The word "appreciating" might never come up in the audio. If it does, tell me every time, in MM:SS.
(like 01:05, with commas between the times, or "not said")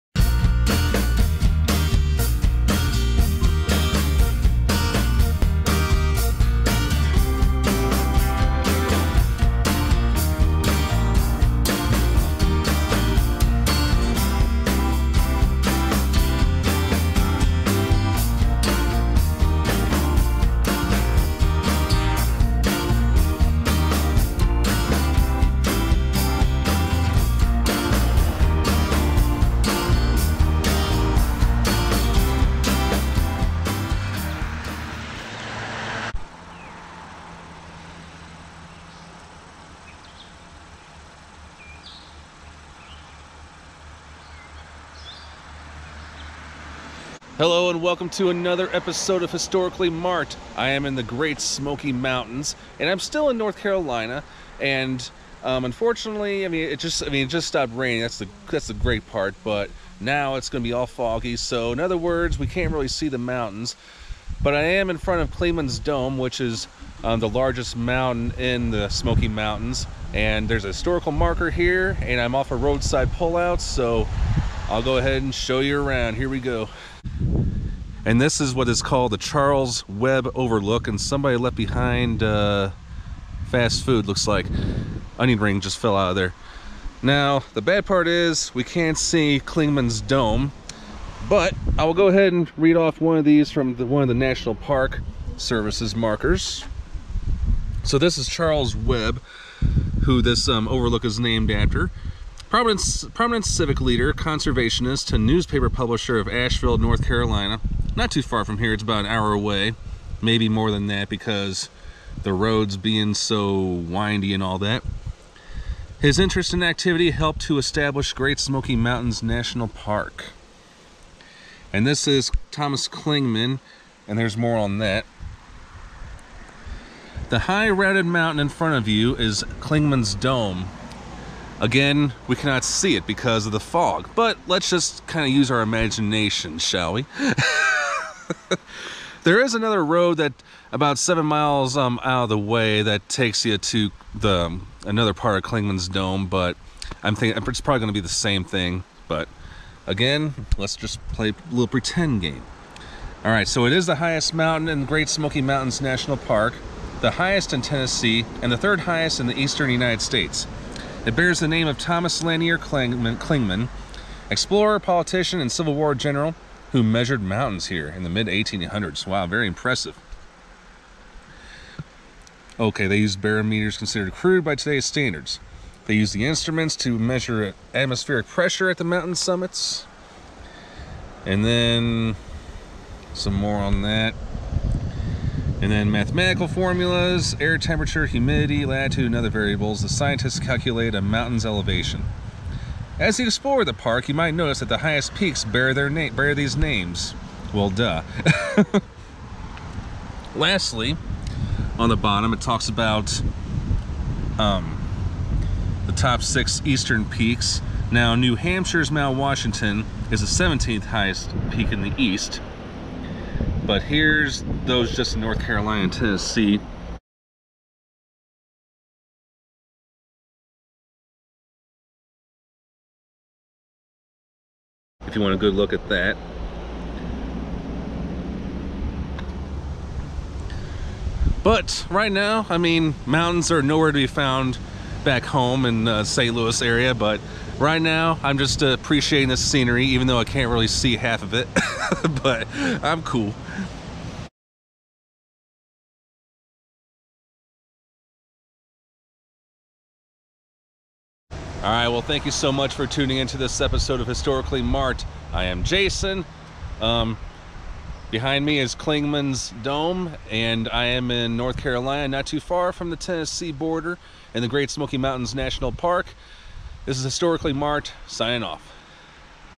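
03:58.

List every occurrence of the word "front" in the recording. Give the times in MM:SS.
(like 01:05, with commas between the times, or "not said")
01:04, 02:08.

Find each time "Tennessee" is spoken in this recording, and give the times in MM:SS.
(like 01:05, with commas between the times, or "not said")
02:37, 03:35, 04:22.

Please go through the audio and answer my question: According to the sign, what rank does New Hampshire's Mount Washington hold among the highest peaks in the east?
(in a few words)
17th.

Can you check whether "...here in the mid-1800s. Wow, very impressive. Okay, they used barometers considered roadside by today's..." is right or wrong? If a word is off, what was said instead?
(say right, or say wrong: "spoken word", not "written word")
wrong: "crude", not "roadside".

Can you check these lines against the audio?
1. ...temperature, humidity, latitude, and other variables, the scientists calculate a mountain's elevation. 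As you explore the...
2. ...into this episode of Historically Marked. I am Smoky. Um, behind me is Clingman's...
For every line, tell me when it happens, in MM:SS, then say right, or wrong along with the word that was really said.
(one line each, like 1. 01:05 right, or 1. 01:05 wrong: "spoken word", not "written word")
1. 03:07 right
2. 04:13 wrong: "Jason", not "Smoky".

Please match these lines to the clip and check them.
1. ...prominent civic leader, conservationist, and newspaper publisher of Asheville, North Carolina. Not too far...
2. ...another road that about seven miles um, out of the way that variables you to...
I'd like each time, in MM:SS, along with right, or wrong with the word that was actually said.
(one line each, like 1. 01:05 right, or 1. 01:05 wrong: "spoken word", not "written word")
1. 01:43 right
2. 02:19 wrong: "takes", not "variables".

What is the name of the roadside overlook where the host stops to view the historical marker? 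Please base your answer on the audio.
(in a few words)
Charles Webb Overlook.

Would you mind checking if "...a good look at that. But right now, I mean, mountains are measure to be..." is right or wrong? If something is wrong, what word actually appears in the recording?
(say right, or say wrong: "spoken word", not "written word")
wrong: "nowhere", not "measure".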